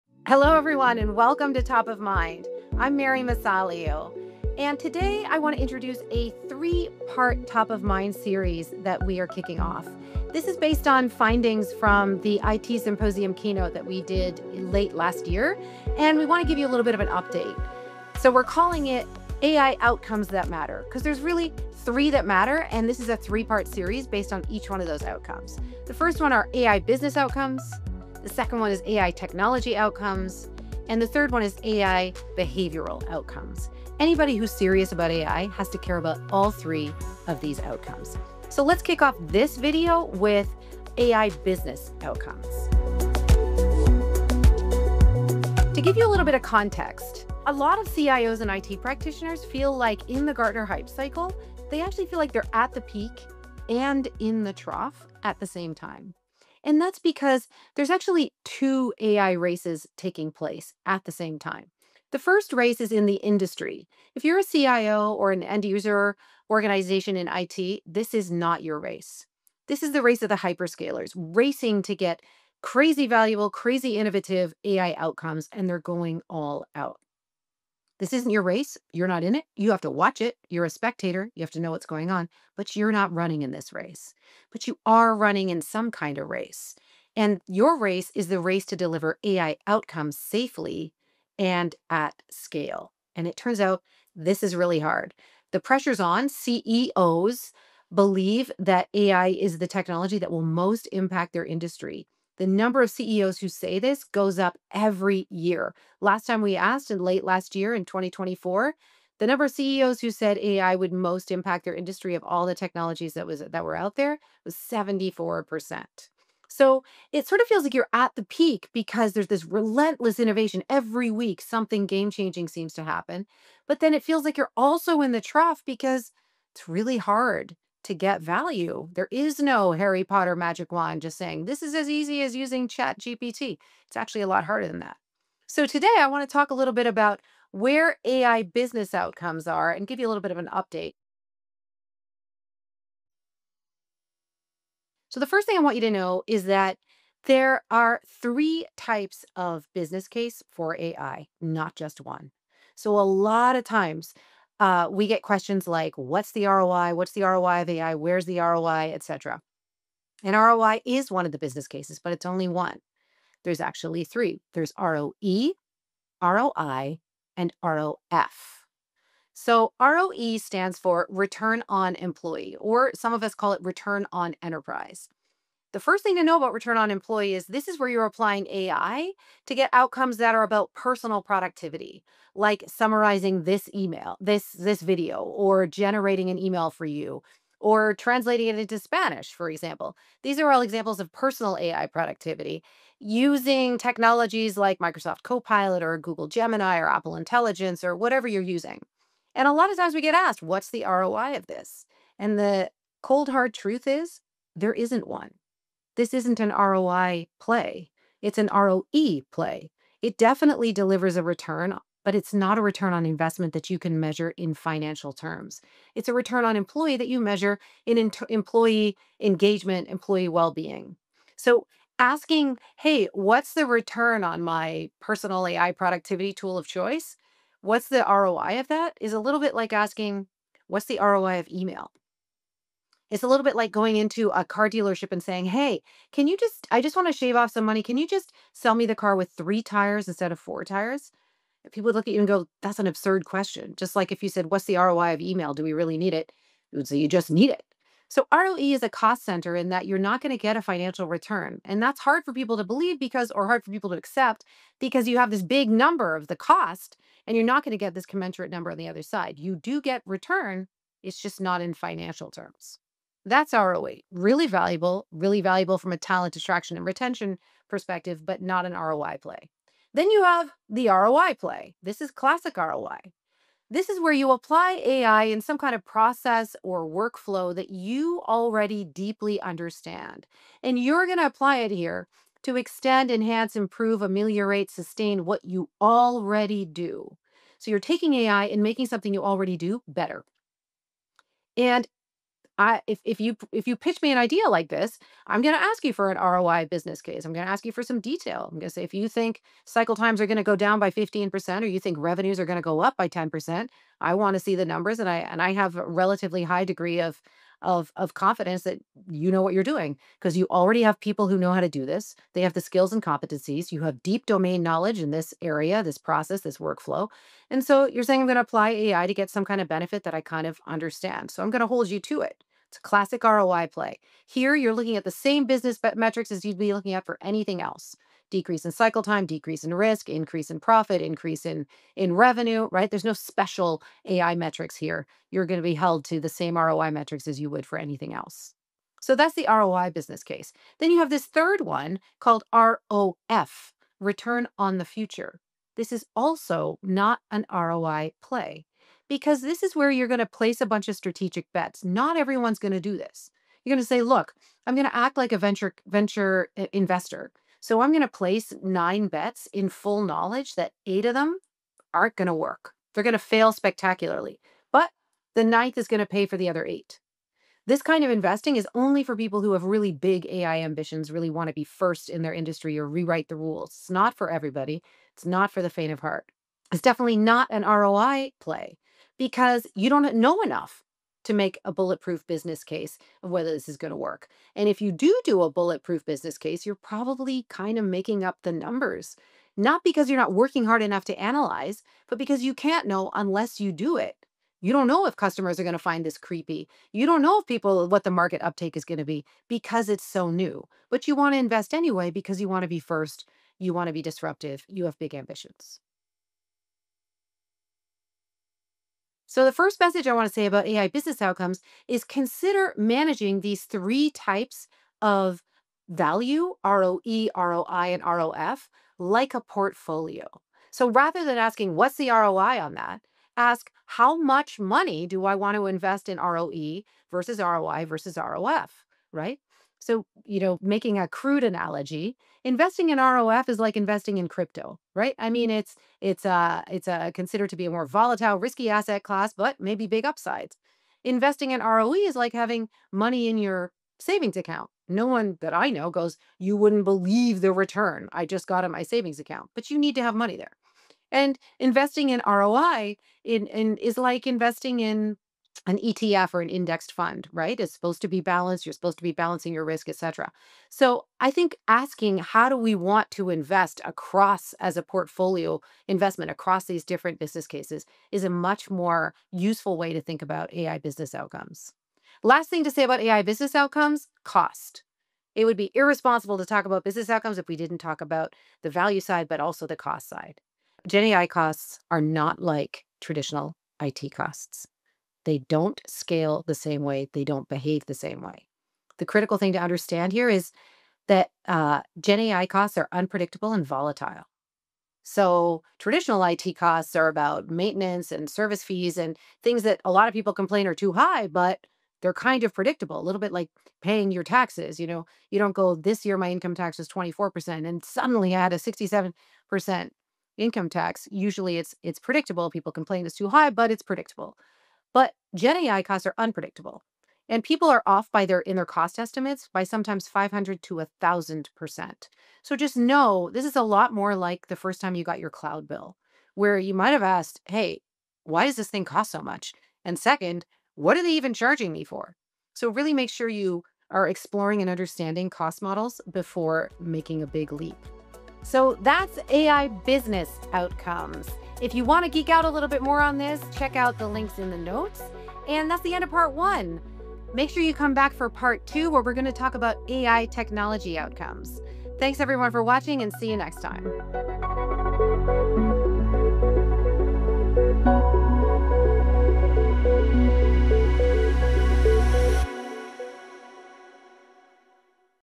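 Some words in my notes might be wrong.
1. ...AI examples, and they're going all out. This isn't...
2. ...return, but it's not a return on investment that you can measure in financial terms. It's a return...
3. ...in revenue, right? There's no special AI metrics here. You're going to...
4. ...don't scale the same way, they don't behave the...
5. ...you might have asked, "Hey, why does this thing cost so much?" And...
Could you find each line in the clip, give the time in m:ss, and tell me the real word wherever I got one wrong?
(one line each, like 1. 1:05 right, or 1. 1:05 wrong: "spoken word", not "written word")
1. 1:14 wrong: "outcomes", not "examples"
2. 3:31 right
3. 5:31 right
4. 8:05 right
5. 8:46 right.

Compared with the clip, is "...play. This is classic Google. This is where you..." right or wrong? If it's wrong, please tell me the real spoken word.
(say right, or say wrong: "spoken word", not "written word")
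wrong: "ROI", not "Google".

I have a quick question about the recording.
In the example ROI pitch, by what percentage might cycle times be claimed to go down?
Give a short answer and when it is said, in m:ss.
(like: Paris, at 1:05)
15%, at 5:00.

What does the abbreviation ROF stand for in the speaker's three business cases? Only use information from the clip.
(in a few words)
return on the future.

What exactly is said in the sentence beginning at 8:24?
You know, you don't go this year, my income tax is 24% and suddenly I had a 67% income tax.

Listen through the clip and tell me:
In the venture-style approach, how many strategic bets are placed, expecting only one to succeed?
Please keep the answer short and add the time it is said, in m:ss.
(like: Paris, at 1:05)
9, at 5:58.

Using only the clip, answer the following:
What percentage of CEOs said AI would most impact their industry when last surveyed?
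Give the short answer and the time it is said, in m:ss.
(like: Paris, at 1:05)
74%, at 1:54.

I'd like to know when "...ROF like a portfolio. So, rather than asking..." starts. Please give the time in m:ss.
6:58.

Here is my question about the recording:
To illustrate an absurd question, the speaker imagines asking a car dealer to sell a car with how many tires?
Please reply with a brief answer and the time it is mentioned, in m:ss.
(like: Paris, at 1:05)
3, at 3:59.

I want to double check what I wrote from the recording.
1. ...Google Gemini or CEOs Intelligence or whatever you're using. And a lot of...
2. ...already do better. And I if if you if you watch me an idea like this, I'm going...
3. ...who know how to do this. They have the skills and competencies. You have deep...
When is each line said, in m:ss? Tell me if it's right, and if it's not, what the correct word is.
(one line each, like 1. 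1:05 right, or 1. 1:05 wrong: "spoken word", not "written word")
1. 3:15 wrong: "Apple", not "CEOs"
2. 4:49 wrong: "pitch", not "watch"
3. 5:11 right.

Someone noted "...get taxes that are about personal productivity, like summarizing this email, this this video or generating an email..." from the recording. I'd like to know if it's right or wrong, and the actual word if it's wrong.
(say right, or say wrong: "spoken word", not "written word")
wrong: "outcomes", not "taxes".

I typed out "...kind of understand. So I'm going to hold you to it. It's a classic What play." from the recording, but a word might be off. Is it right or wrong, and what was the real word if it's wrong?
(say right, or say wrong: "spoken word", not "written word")
wrong: "ROI", not "What".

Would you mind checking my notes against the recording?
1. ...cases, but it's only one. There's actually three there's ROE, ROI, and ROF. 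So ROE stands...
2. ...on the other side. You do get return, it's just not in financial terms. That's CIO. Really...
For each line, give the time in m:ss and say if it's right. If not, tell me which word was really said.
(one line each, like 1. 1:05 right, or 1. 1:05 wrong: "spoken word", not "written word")
1. 2:41 right
2. 4:18 wrong: "ROE", not "CIO".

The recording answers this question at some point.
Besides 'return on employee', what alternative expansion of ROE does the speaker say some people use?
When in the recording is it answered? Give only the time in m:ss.
2:53.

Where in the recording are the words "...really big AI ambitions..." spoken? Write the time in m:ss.
6:09.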